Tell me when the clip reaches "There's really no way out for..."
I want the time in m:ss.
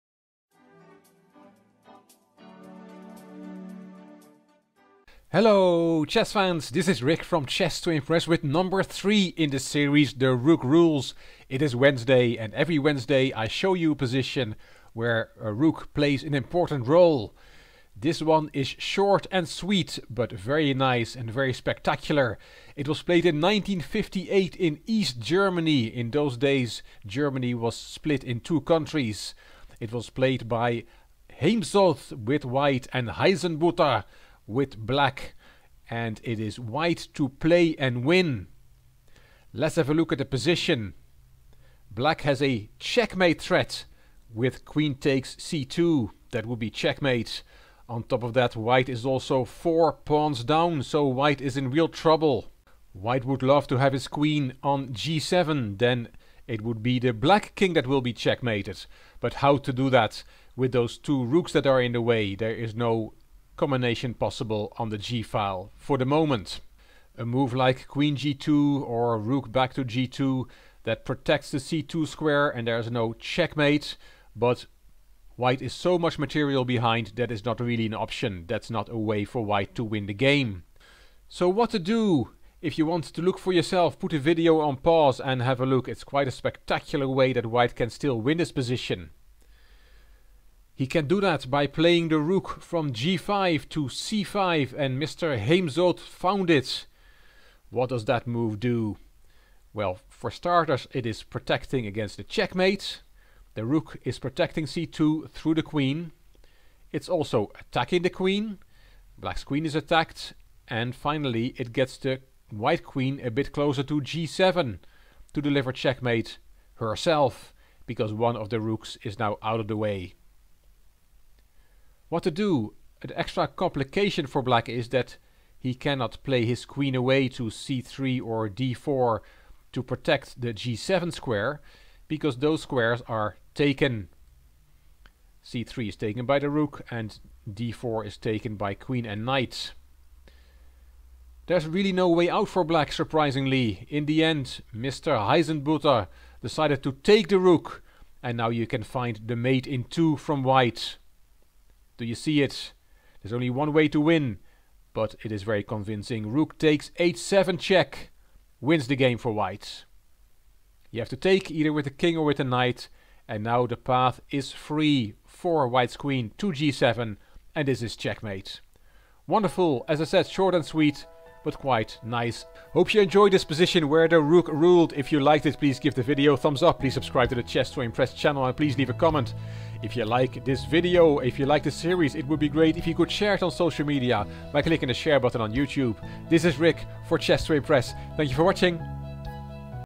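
2:21.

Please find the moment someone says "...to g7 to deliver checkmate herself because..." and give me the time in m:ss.
1:53.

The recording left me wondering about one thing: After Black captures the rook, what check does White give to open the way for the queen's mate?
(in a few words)
Rook takes h7.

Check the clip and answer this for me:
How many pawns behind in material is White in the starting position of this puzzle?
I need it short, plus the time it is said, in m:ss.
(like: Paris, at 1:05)
4, at 0:49.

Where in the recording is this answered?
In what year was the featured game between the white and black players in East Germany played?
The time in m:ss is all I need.
0:23.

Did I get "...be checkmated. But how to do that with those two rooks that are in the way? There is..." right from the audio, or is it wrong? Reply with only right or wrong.
right.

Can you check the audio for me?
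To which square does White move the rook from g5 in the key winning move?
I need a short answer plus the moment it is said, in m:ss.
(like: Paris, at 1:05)
c5, at 1:33.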